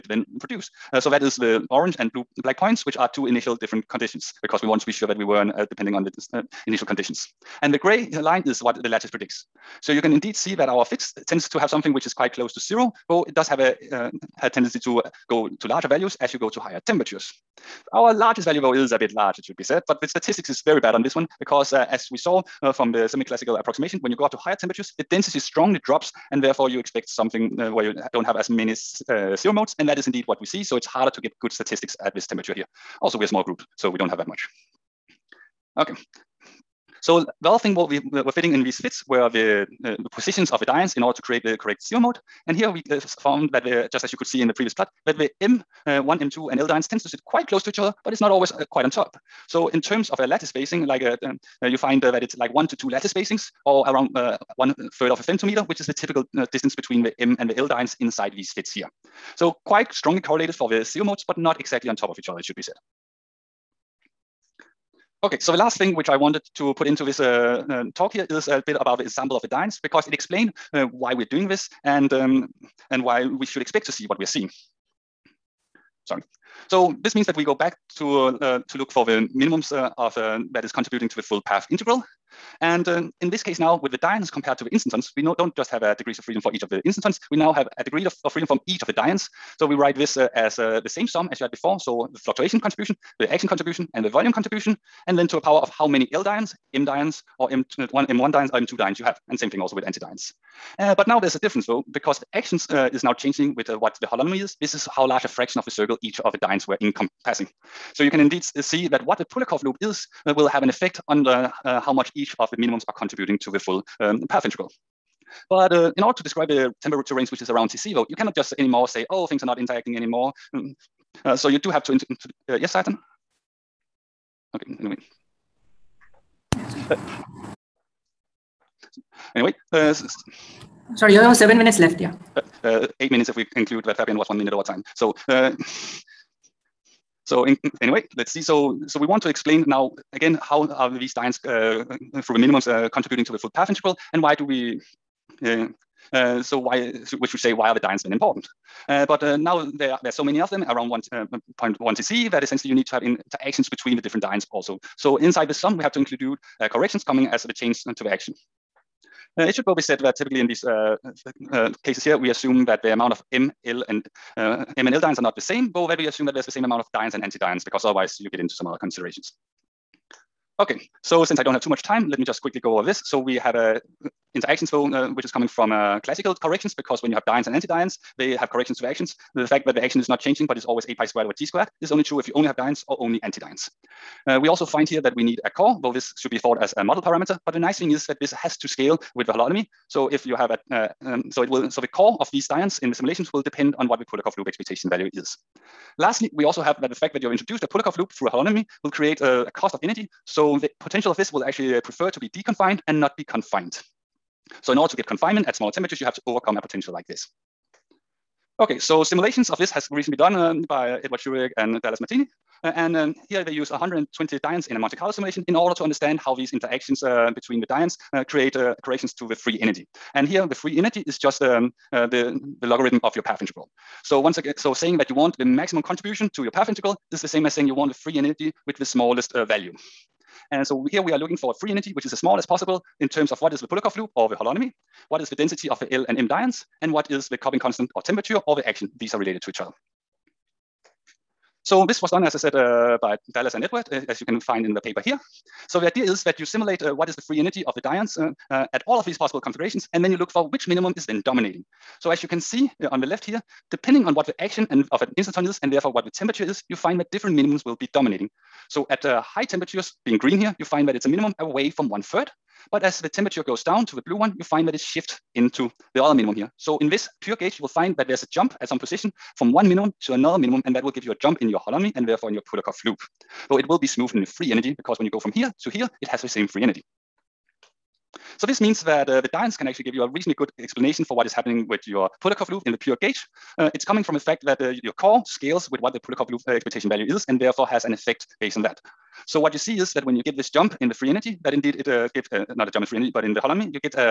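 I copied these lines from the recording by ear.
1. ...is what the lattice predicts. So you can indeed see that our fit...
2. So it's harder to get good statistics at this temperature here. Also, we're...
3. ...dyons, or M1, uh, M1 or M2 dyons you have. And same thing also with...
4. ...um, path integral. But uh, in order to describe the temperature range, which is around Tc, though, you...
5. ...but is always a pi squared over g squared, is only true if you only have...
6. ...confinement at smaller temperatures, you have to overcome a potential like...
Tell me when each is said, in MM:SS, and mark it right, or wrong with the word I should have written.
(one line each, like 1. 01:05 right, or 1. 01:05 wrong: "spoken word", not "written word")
1. 00:08 right
2. 00:30 right
3. 01:36 right
4. 01:53 right
5. 03:00 right
6. 03:25 right.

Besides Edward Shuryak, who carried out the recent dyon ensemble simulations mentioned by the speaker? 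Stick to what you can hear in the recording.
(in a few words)
Dallas Martini.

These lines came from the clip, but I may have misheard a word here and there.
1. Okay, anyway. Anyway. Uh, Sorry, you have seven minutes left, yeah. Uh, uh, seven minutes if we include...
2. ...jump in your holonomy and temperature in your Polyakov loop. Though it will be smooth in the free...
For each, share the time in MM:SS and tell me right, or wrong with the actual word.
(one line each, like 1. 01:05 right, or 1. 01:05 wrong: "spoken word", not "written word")
1. 02:04 wrong: "eight", not "seven"
2. 04:31 wrong: "therefore", not "temperature".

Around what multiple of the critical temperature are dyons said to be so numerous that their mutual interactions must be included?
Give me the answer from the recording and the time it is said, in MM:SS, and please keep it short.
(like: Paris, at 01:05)
1.1 Tc, at 02:30.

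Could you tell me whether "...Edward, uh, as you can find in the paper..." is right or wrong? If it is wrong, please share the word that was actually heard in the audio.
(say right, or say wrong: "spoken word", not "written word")
right.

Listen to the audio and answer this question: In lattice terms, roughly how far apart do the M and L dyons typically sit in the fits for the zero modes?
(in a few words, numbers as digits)
1 to 2 lattice spacings.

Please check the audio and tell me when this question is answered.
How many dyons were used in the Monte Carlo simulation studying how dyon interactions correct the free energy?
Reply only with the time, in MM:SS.
03:33.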